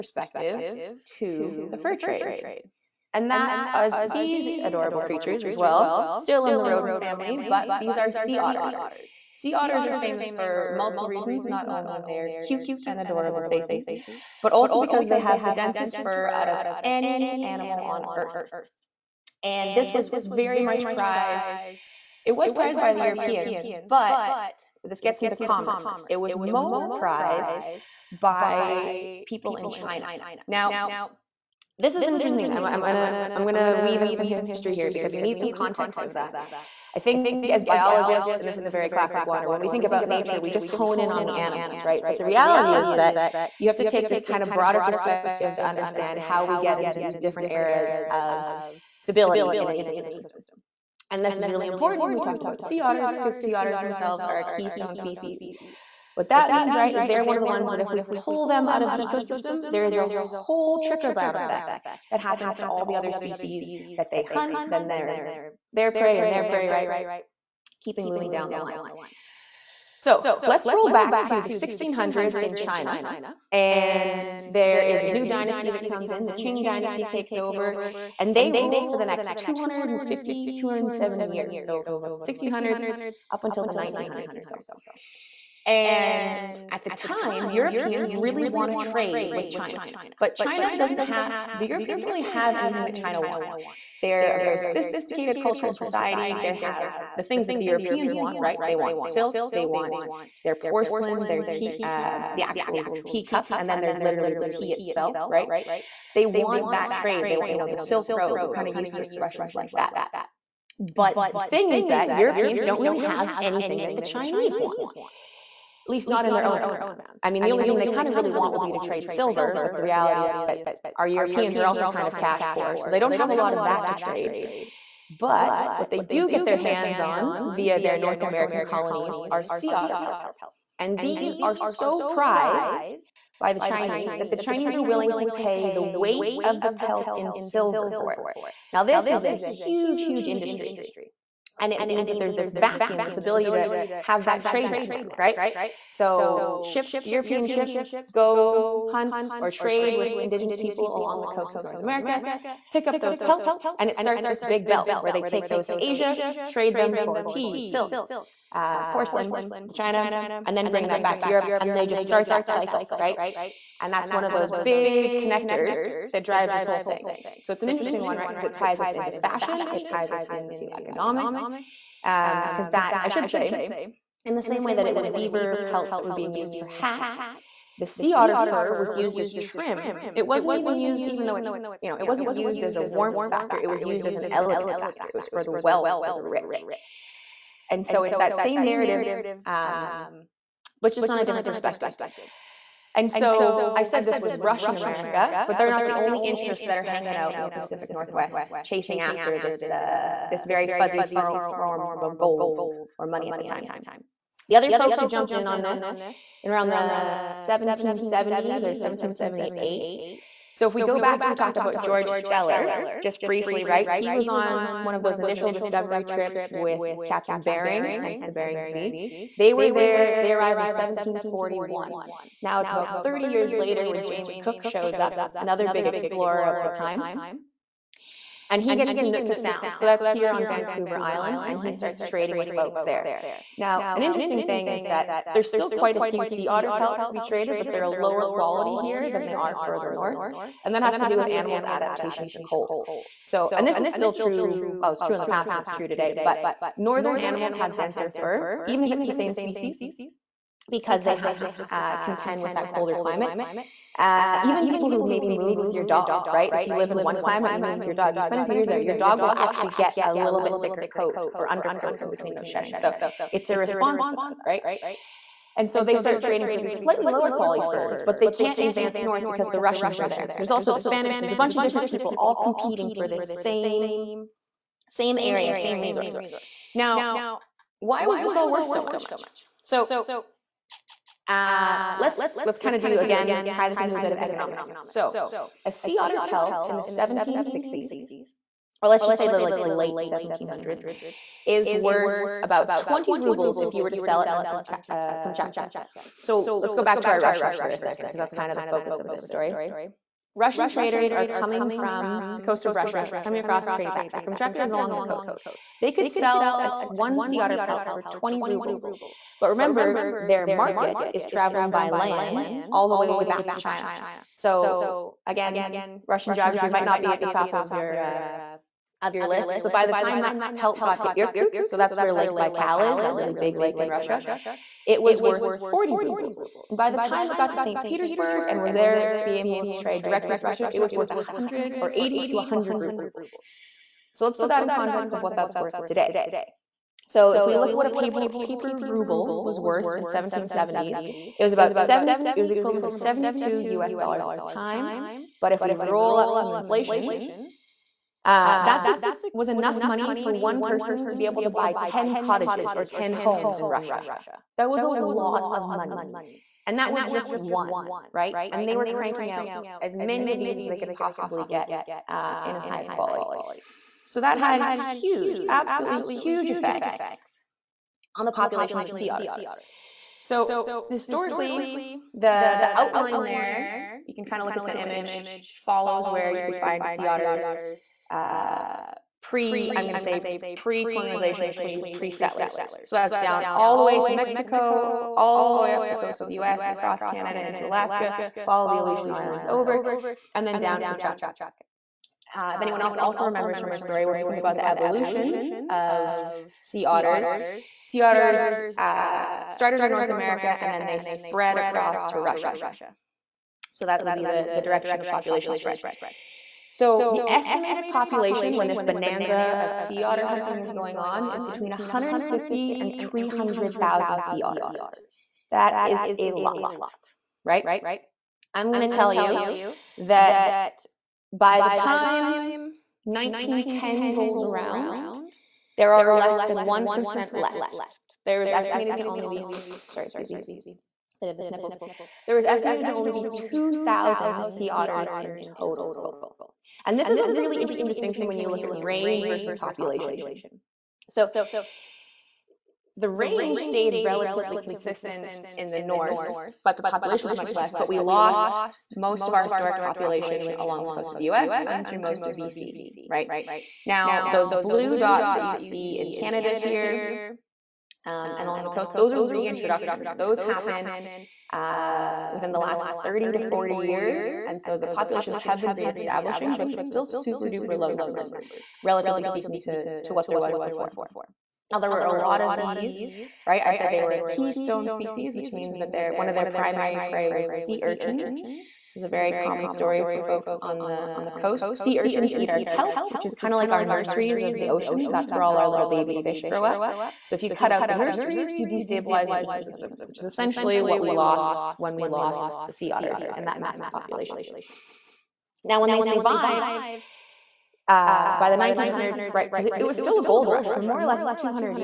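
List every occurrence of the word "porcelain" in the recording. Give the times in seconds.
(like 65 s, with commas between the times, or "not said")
100 s, 158 s.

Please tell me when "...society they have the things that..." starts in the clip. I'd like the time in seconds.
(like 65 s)
95 s.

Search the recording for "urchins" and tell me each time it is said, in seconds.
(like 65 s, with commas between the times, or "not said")
477 s, 481 s.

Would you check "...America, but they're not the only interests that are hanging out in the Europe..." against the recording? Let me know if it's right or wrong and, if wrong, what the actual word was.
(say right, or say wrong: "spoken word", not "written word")
wrong: "Pacific", not "Europe".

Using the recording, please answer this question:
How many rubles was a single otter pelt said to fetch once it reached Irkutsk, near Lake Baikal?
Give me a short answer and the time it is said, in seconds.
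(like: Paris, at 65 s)
40 rubles, at 325 s.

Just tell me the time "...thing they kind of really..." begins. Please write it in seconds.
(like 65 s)
117 s.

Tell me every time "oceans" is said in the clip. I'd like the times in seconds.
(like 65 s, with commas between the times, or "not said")
484 s.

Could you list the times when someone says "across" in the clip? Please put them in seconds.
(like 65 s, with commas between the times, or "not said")
303 s, 386 s, 401 s.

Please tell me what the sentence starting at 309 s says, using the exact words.
But remember, their market is traveling by land all the way back to China.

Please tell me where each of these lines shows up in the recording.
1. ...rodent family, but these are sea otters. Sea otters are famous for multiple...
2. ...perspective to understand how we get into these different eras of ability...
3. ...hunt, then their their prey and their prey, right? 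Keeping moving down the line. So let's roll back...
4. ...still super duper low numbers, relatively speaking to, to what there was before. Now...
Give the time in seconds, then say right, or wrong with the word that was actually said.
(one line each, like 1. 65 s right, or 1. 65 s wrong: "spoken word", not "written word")
1. 6 s right
2. 44 s wrong: "stability", not "ability"
3. 64 s right
4. 466 s right.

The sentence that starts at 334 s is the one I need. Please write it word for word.
So let's put that in context of what that's worth today.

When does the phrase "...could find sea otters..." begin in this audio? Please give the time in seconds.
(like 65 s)
376 s.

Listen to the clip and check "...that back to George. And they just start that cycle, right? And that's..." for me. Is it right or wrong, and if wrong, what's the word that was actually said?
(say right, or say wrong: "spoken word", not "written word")
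wrong: "Europe", not "George".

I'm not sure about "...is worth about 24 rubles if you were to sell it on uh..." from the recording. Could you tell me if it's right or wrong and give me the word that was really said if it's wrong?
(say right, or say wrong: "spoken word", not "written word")
wrong: "20", not "24".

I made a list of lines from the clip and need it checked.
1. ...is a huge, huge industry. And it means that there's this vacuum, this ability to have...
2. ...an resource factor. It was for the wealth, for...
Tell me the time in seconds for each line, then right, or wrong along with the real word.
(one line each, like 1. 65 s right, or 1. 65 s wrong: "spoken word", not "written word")
1. 139 s right
2. 184 s wrong: "elegance", not "resource".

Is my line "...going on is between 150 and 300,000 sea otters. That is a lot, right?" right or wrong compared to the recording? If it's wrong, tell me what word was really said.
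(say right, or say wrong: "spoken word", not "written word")
right.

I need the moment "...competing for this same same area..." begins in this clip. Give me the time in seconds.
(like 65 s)
272 s.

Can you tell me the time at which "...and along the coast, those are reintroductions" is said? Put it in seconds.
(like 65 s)
458 s.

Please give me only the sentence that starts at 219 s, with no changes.
They were there, they arrived in 1741.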